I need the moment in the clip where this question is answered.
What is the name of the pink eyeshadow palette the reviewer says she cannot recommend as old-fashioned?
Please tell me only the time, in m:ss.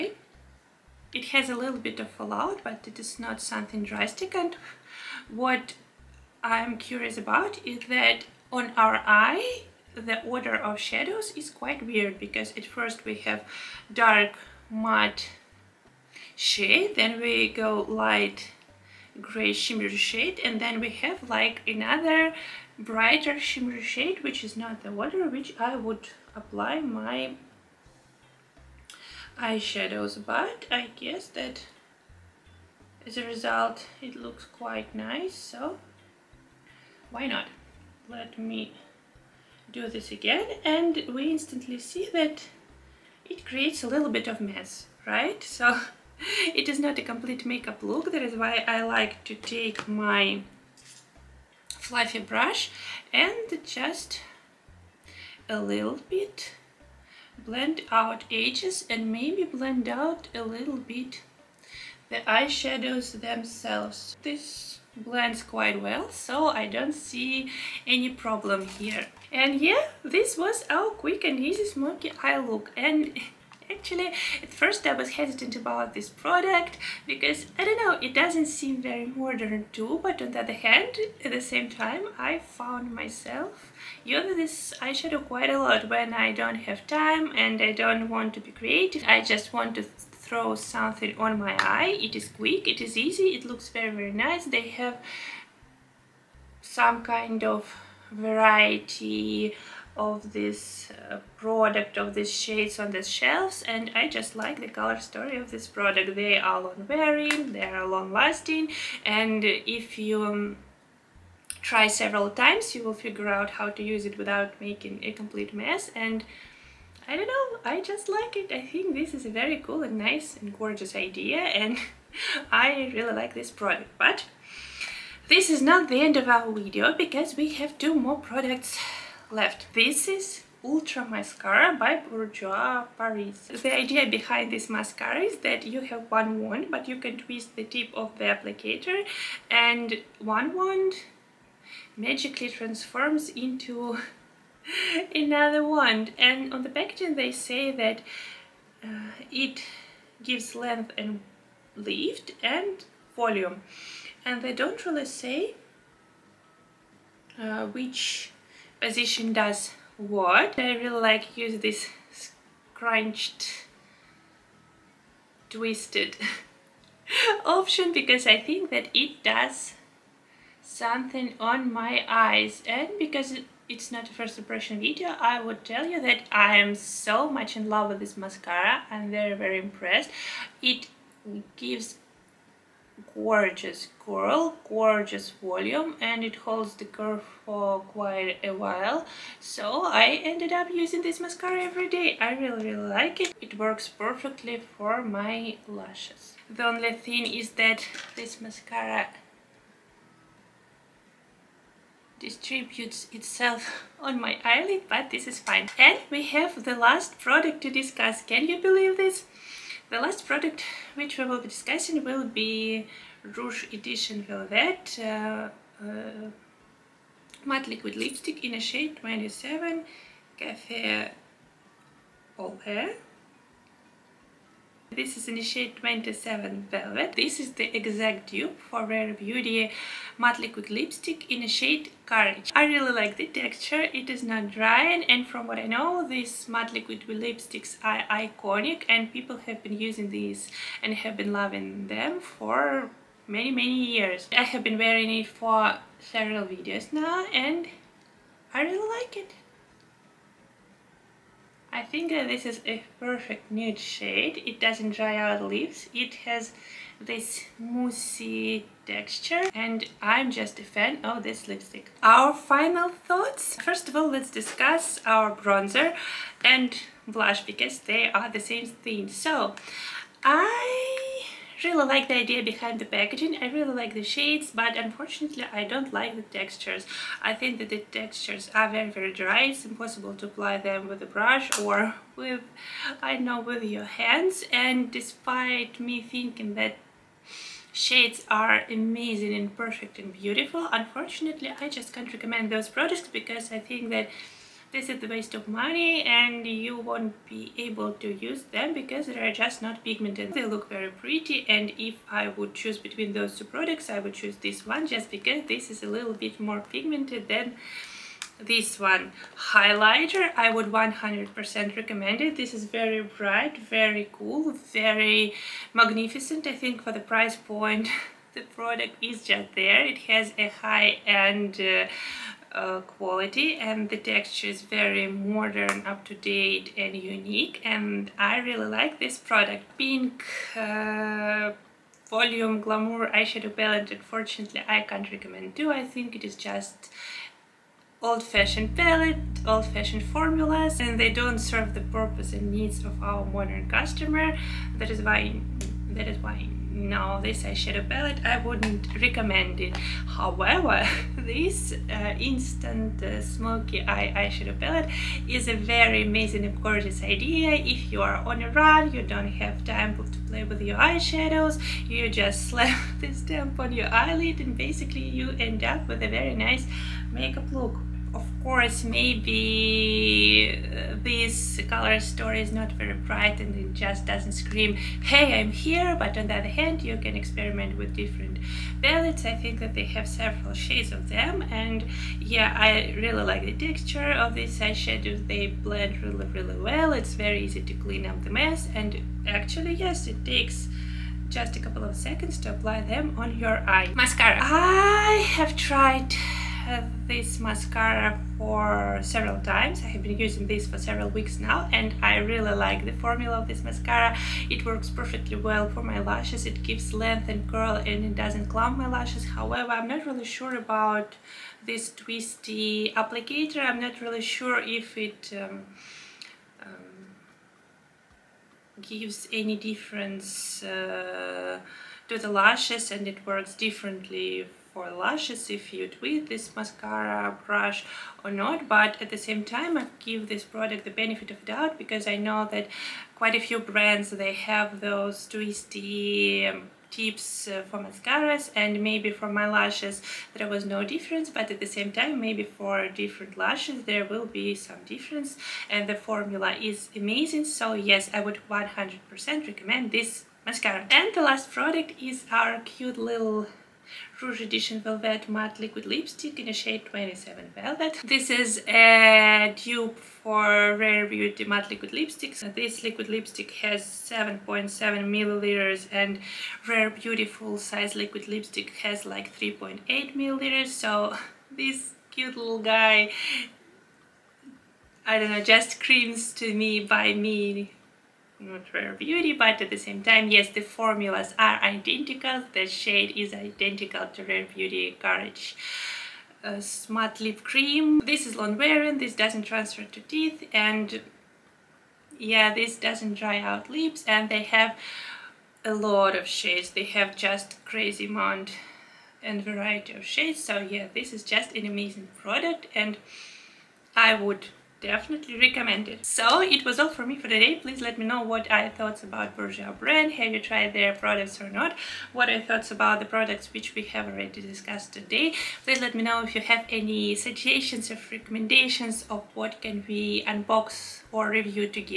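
5:32.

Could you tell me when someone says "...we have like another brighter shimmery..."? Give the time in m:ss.
0:20.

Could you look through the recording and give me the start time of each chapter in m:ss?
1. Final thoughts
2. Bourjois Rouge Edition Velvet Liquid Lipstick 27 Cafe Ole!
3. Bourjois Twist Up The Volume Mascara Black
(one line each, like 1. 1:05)
1. 4:21
2. 3:25
3. 2:09.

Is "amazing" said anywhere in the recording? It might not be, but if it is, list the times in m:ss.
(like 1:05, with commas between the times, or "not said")
4:48, 5:56, 7:26, 8:21.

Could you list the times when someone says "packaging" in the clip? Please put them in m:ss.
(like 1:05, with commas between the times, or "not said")
2:26, 4:32.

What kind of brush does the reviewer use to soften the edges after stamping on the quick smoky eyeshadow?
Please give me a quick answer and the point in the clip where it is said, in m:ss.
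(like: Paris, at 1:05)
Fluffy brush, at 0:51.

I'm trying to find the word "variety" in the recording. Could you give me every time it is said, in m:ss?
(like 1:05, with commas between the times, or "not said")
1:38, 8:19.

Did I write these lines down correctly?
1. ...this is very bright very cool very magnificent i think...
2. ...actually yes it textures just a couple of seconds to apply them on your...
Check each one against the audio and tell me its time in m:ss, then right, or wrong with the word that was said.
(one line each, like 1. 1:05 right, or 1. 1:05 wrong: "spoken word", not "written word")
1. 5:12 right
2. 6:29 wrong: "takes", not "textures".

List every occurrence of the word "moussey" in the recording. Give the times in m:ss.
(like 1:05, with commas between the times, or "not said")
4:17.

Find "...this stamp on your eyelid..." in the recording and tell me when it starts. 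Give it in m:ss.
6:02.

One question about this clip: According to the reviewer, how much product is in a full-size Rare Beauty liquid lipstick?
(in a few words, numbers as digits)
3.8 milliliters.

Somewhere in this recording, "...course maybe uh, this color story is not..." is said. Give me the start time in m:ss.
6:08.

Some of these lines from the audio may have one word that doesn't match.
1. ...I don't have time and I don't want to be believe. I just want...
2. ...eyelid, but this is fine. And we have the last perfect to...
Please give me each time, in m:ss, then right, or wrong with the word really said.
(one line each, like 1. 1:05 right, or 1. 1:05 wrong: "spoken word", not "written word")
1. 1:26 wrong: "creative", not "believe"
2. 3:24 wrong: "product", not "perfect".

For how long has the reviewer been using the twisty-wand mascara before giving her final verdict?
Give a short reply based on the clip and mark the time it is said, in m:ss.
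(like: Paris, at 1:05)
Several weeks, at 6:40.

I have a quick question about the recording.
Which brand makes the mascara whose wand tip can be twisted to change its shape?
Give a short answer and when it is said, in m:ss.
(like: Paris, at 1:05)
Bourjois Paris, at 2:12.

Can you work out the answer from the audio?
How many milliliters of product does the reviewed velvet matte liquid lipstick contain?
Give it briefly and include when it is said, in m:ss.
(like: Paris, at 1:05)
7.7 milliliters, at 7:43.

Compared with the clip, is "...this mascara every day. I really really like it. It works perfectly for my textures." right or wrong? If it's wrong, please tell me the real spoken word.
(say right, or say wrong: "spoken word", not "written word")
wrong: "lashes", not "textures".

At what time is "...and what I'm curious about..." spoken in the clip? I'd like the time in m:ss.
0:04.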